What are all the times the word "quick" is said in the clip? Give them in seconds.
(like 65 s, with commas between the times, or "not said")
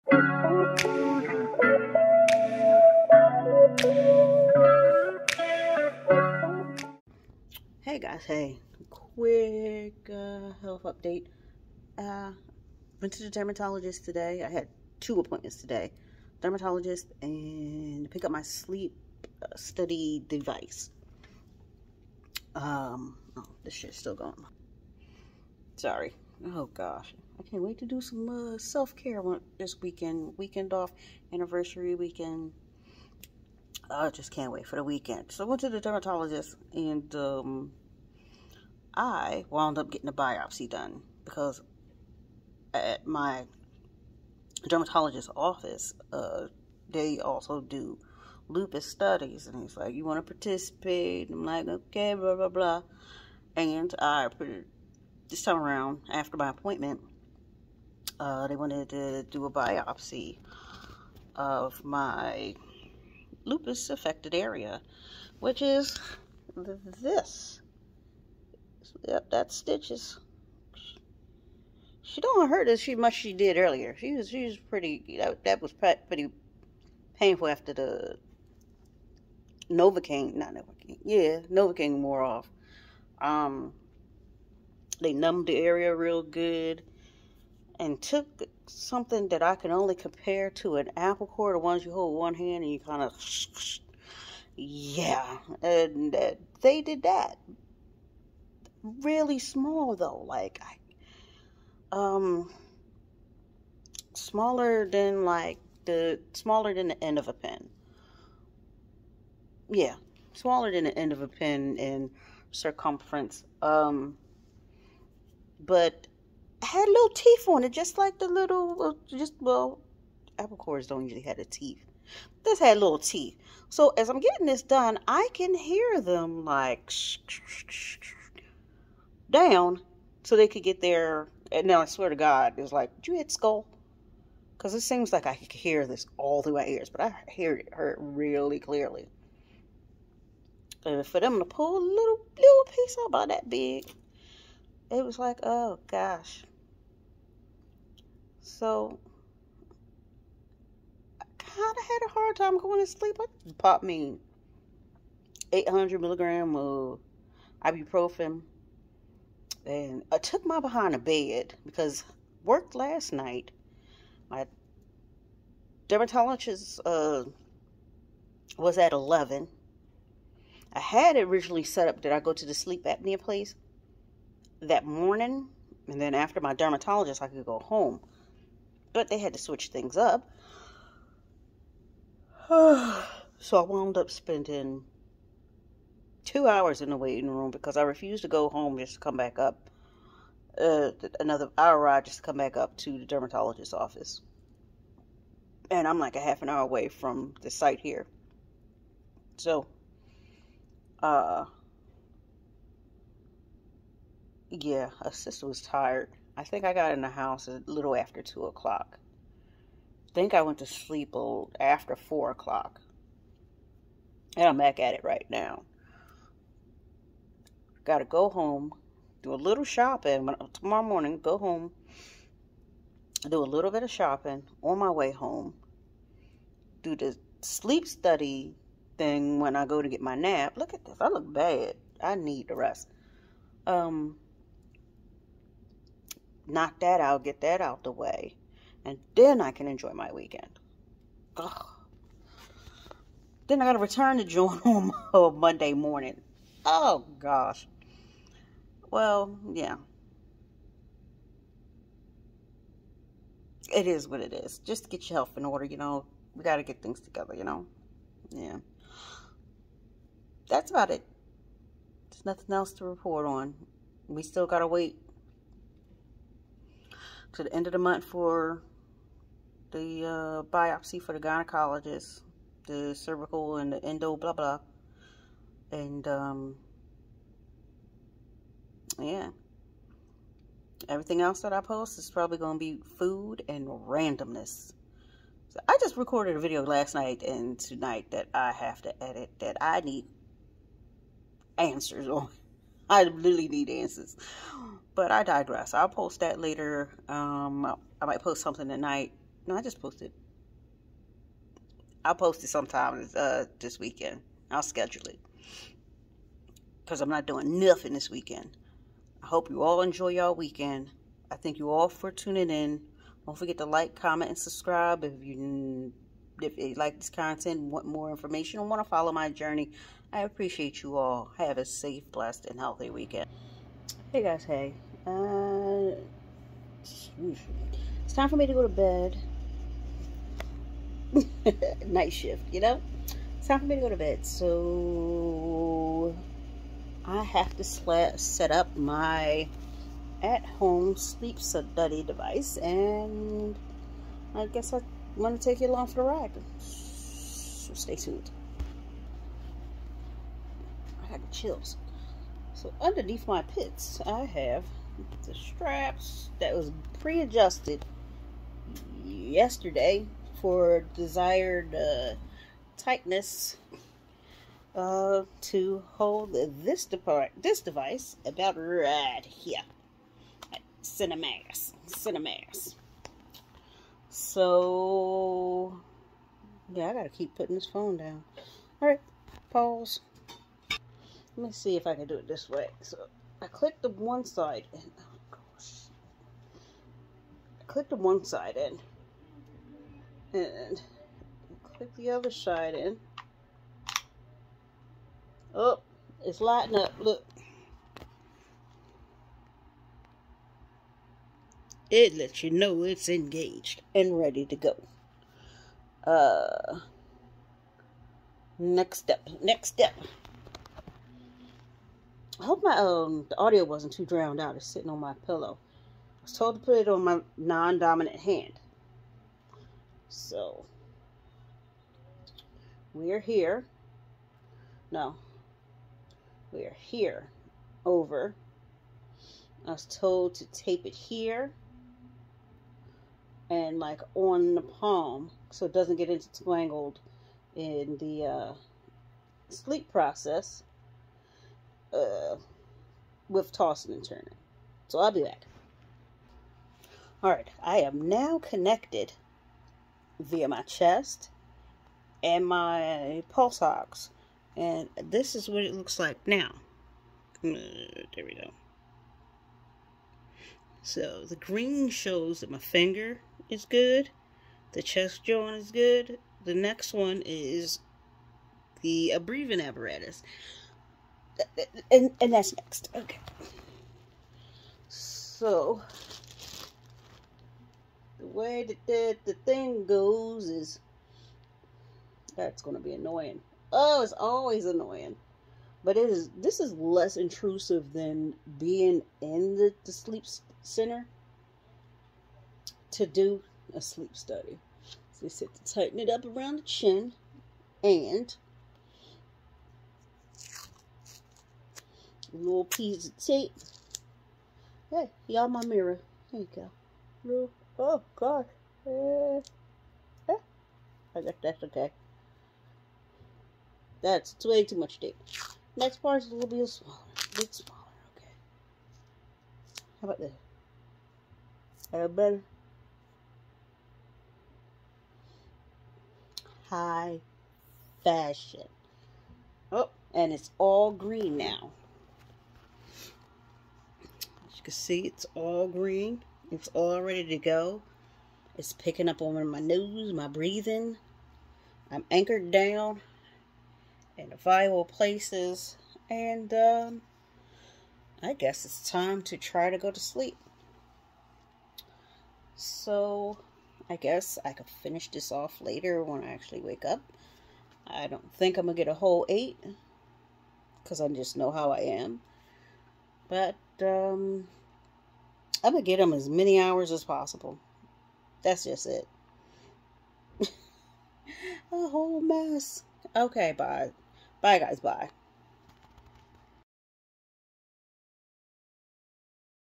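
8 s.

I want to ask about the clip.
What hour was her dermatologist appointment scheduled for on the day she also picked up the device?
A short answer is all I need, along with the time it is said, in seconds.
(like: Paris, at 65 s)
11, at 168 s.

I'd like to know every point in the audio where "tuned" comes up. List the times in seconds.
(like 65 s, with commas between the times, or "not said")
347 s.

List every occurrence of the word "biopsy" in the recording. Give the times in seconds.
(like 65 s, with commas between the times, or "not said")
40 s, 59 s, 270 s.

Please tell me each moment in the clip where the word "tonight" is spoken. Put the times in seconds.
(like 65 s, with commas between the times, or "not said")
287 s, 298 s.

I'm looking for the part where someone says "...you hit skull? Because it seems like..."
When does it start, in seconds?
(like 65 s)
133 s.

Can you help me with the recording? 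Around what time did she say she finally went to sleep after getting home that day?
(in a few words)
4 o'clock.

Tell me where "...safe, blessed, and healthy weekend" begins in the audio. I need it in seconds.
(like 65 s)
321 s.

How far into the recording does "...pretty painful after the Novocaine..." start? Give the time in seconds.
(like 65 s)
75 s.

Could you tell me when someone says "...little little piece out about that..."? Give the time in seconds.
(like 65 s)
141 s.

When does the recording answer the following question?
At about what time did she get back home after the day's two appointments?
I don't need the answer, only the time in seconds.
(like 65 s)
208 s.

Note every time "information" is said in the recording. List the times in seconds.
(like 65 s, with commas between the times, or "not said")
318 s.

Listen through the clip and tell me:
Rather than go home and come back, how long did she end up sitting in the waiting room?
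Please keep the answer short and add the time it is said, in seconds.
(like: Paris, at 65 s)
2 hours, at 186 s.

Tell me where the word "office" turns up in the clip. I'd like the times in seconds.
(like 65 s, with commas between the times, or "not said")
45 s, 193 s.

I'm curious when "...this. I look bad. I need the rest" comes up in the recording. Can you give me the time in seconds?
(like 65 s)
230 s.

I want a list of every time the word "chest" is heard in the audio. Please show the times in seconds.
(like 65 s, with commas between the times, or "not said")
450 s, 464 s.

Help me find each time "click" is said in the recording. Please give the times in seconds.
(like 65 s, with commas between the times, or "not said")
383 s, 387 s, 391 s.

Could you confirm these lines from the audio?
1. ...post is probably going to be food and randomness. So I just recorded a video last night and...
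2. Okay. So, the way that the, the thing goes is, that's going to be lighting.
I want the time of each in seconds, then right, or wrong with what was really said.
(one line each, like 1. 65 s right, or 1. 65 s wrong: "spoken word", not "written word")
1. 281 s right
2. 472 s wrong: "annoying", not "lighting".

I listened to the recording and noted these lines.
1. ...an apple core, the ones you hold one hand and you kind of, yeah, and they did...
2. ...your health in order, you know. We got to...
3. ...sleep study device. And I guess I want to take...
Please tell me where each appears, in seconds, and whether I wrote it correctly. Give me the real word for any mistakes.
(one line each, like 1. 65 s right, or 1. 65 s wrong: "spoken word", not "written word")
1. 90 s right
2. 255 s right
3. 340 s right.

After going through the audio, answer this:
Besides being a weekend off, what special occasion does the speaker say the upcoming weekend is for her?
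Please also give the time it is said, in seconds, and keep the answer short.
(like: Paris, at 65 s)
anniversary, at 31 s.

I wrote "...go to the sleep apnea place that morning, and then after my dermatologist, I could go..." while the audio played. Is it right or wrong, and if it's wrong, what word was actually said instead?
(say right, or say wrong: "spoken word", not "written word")
right.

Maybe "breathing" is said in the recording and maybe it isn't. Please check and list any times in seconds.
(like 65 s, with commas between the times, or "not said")
469 s, 540 s.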